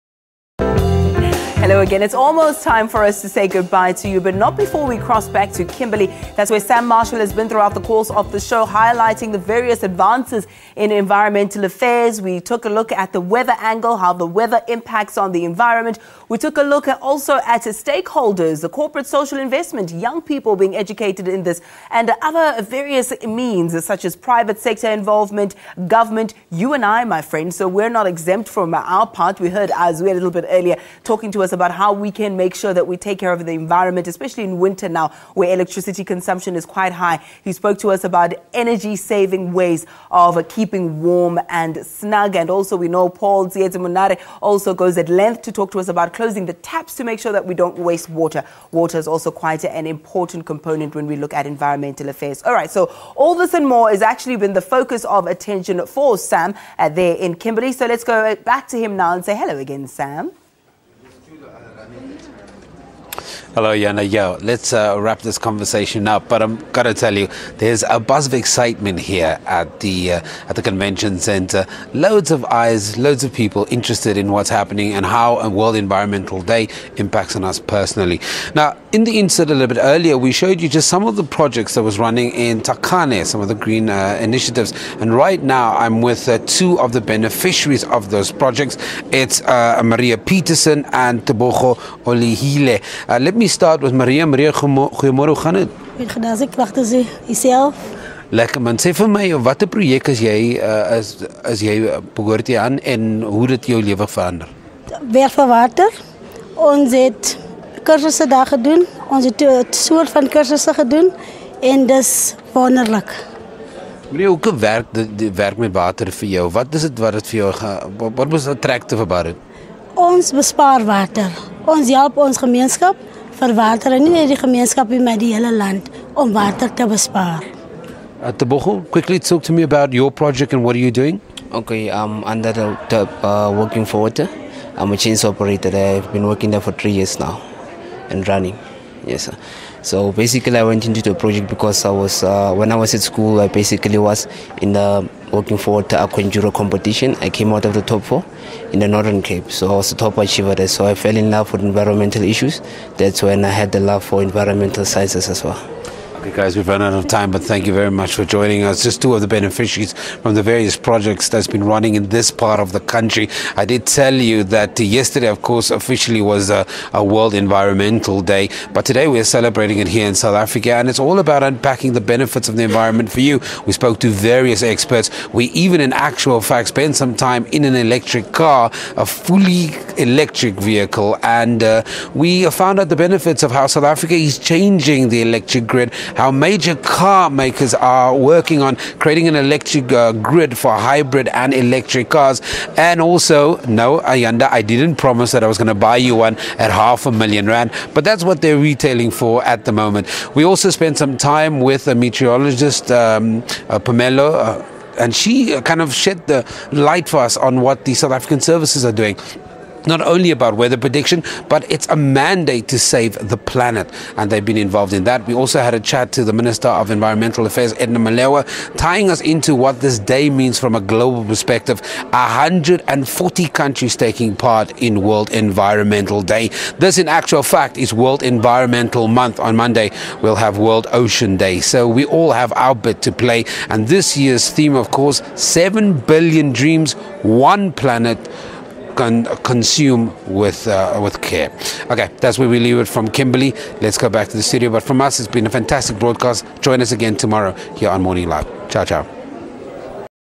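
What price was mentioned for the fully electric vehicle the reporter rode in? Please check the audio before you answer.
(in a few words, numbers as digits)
half a million rand.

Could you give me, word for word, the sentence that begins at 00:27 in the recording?
So we're not exempt from our part.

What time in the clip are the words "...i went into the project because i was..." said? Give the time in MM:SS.
02:20.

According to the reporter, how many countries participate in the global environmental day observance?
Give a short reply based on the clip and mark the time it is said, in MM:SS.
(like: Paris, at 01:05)
140, at 03:42.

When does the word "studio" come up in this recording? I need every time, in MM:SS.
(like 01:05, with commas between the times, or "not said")
04:04.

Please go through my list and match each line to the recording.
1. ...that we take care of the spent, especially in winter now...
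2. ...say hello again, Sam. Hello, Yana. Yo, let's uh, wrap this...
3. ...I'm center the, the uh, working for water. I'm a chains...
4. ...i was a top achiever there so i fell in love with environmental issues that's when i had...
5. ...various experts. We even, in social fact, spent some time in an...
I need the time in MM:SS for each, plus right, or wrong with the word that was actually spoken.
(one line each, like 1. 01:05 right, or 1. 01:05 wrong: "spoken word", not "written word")
1. 00:32 wrong: "environment", not "spent"
2. 00:59 right
3. 02:11 wrong: "under", not "center"
4. 02:29 right
5. 02:54 wrong: "actual", not "social".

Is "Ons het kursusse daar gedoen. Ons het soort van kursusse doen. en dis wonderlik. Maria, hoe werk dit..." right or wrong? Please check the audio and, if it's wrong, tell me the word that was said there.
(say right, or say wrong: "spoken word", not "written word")
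right.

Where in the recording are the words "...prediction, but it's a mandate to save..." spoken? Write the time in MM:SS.
03:30.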